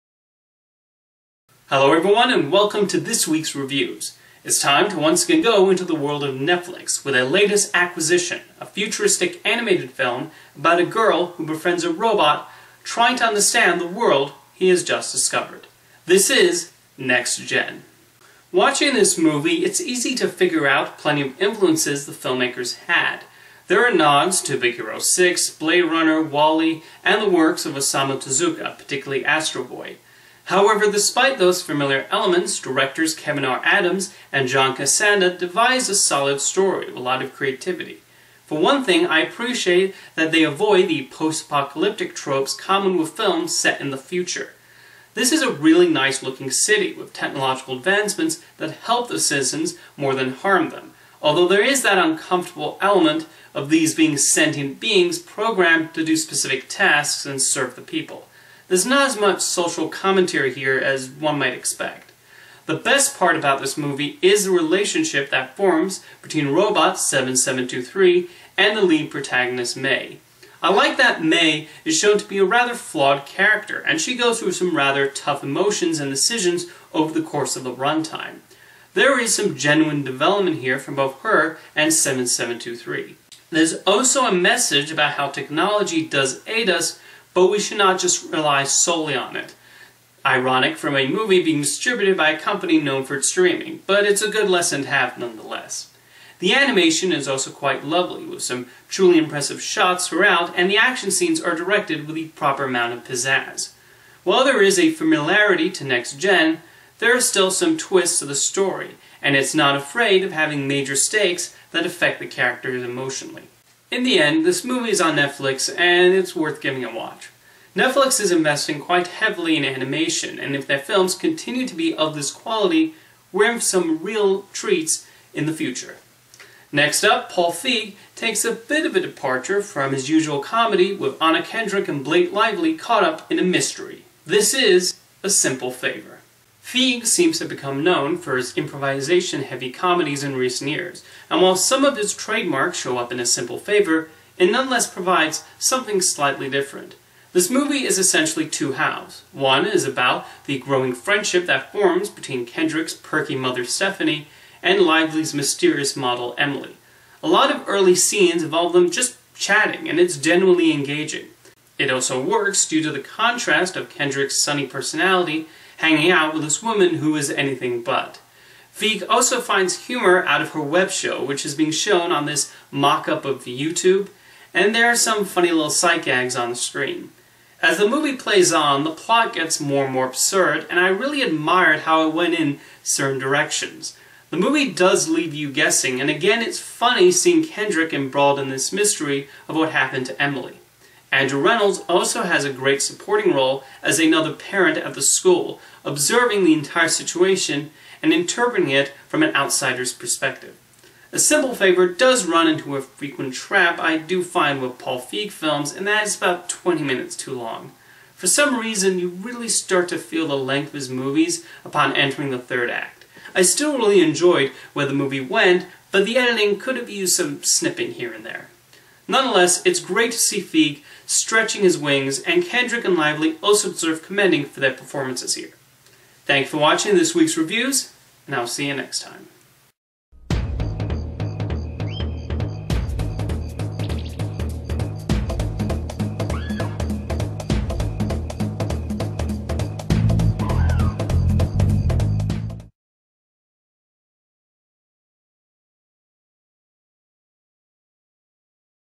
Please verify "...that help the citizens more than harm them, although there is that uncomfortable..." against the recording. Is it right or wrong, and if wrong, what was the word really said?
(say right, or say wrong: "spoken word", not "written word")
right.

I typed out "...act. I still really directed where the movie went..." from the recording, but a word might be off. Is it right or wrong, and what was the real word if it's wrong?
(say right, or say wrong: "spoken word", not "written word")
wrong: "enjoyed", not "directed".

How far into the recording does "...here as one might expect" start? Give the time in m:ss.
1:00.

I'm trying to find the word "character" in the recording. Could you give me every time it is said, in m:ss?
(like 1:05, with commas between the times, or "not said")
1:13, 1:52.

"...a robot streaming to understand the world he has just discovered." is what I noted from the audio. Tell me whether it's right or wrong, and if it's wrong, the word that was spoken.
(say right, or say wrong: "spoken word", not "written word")
wrong: "trying", not "streaming".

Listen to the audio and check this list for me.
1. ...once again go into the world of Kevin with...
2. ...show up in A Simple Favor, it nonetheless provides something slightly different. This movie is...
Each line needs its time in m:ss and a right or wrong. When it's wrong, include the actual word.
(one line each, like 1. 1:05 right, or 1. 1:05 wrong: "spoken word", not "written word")
1. 0:04 wrong: "Netflix", not "Kevin"
2. 2:22 right.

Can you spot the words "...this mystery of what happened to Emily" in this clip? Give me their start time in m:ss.
3:08.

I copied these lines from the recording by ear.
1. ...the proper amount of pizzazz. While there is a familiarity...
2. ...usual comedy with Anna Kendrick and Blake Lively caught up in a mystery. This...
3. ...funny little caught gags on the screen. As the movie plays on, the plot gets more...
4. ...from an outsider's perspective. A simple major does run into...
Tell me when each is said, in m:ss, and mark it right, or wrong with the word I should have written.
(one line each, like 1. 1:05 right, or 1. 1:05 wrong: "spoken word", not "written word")
1. 1:42 right
2. 2:10 right
3. 2:55 wrong: "sight", not "caught"
4. 3:19 wrong: "favor", not "major".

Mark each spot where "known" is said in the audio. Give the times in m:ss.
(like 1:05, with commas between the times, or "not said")
1:32, 2:17.